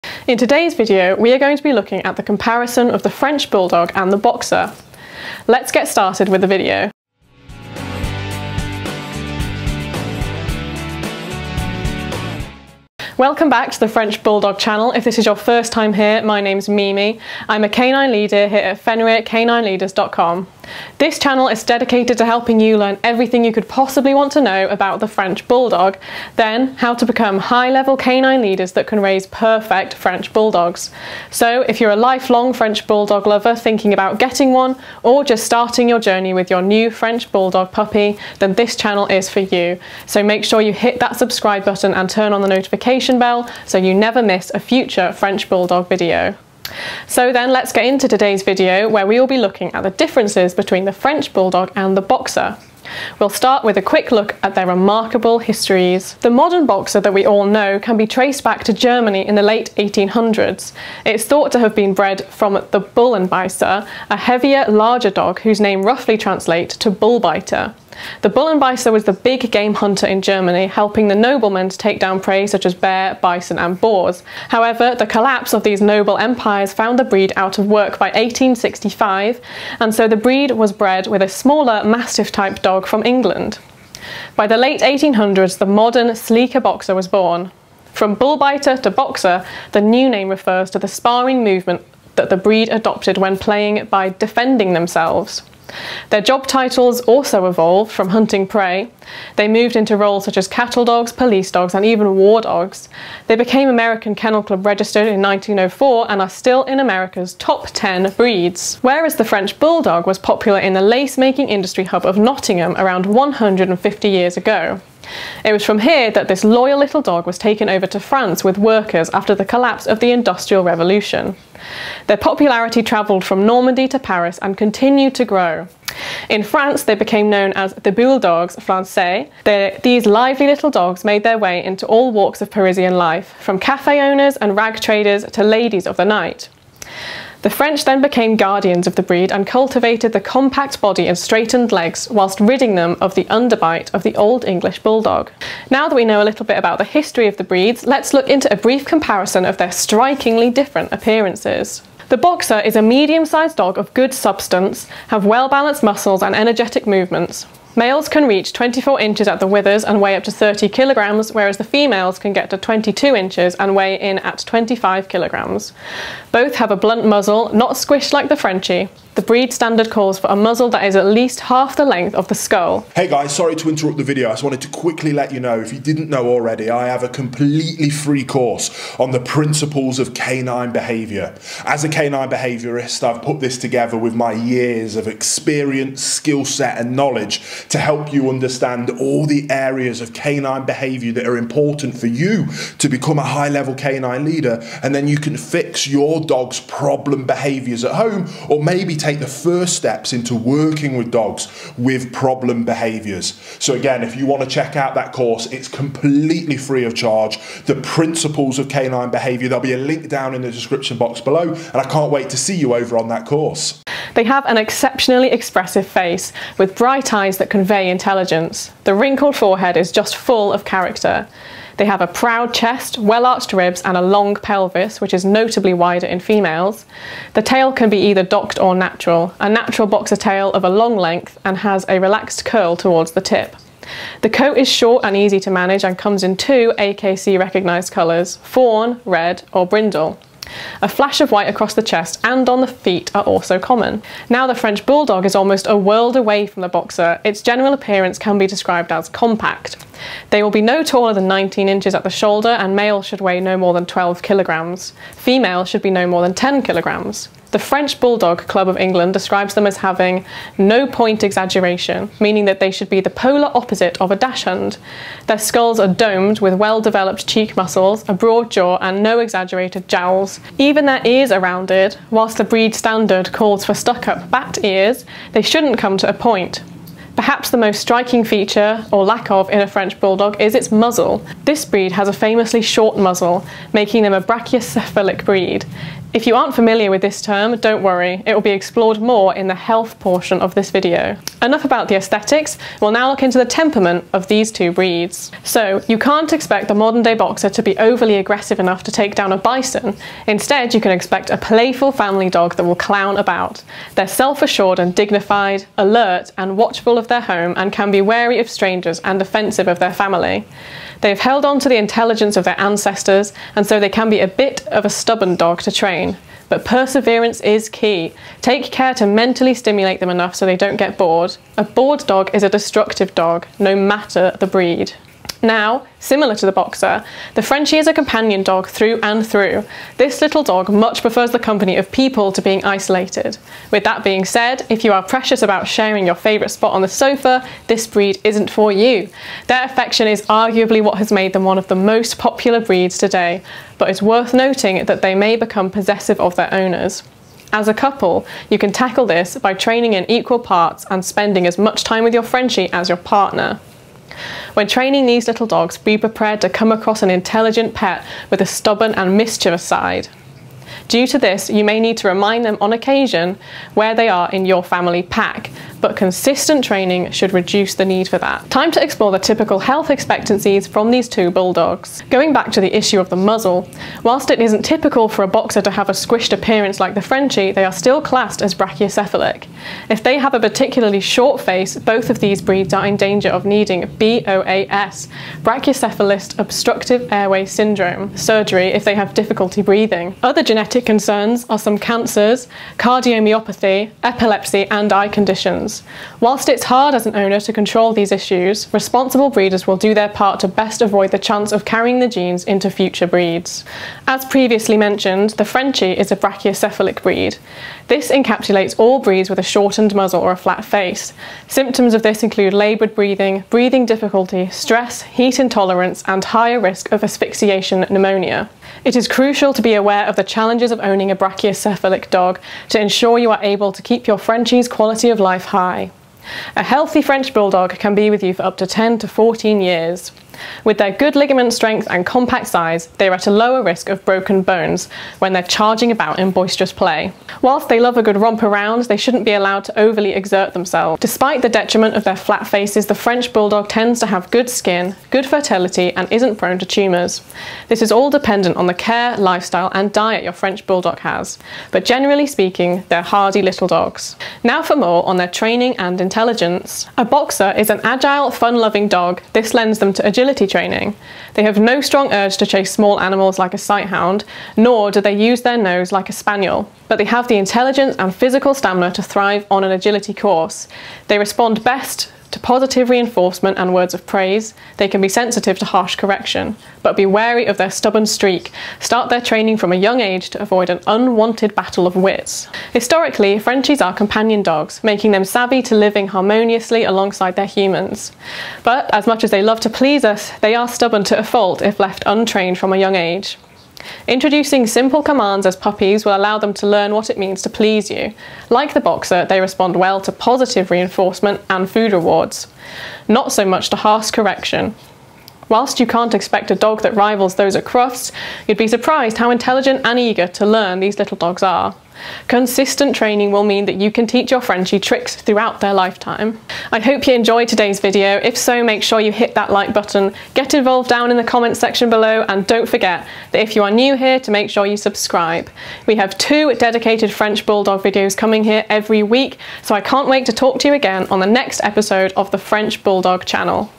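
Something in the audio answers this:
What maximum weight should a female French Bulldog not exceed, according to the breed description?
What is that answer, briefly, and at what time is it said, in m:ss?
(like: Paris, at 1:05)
10 kilograms, at 4:16.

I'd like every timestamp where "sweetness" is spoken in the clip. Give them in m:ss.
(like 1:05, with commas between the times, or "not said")
not said.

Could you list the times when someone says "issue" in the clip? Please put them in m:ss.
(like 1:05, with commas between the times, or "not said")
6:12, 6:38.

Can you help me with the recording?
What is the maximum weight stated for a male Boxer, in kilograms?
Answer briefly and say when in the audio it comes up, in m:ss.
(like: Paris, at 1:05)
30 kilograms, at 2:40.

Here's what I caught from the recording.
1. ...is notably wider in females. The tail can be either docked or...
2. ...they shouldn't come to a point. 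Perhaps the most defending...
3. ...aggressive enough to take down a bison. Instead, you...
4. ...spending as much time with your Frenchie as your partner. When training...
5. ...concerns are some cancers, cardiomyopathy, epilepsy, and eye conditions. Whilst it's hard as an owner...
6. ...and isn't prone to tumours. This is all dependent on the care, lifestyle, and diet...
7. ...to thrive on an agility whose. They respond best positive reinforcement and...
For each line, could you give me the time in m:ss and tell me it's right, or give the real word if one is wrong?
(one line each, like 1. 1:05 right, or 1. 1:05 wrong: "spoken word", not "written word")
1. 3:45 right
2. 4:35 wrong: "striking", not "defending"
3. 4:58 right
4. 5:51 right
5. 6:30 right
6. 7:25 right
7. 7:48 wrong: "course", not "whose".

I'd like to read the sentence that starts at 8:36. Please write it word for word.
I hope you enjoyed today's video.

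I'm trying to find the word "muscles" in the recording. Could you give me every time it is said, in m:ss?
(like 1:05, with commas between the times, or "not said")
2:35, 4:27.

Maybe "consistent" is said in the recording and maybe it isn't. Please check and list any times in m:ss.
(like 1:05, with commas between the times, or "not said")
6:05, 8:32.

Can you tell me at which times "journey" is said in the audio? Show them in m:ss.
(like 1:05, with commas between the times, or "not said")
0:35.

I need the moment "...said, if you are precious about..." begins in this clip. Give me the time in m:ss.
5:34.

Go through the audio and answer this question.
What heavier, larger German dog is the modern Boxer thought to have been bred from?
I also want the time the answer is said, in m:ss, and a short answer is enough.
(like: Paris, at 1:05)
Bullenbeißer, at 1:02.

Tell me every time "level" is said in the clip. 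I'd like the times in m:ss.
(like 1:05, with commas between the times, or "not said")
0:27, 3:13.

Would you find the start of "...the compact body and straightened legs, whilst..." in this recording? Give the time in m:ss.
2:20.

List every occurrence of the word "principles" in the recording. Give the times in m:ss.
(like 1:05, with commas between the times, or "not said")
2:59, 3:27.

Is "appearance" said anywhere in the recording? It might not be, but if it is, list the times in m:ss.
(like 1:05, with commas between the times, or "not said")
2:30, 4:07, 6:16.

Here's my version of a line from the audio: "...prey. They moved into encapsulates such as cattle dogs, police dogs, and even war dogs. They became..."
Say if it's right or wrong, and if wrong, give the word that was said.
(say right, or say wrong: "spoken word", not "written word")
wrong: "roles", not "encapsulates".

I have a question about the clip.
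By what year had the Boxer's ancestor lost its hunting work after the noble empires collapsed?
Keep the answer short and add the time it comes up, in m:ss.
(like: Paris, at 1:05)
1865, at 1:18.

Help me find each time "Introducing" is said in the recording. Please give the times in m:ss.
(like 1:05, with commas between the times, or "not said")
8:14.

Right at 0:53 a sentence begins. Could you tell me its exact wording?
We'll start with a quick look at their remarkable histories.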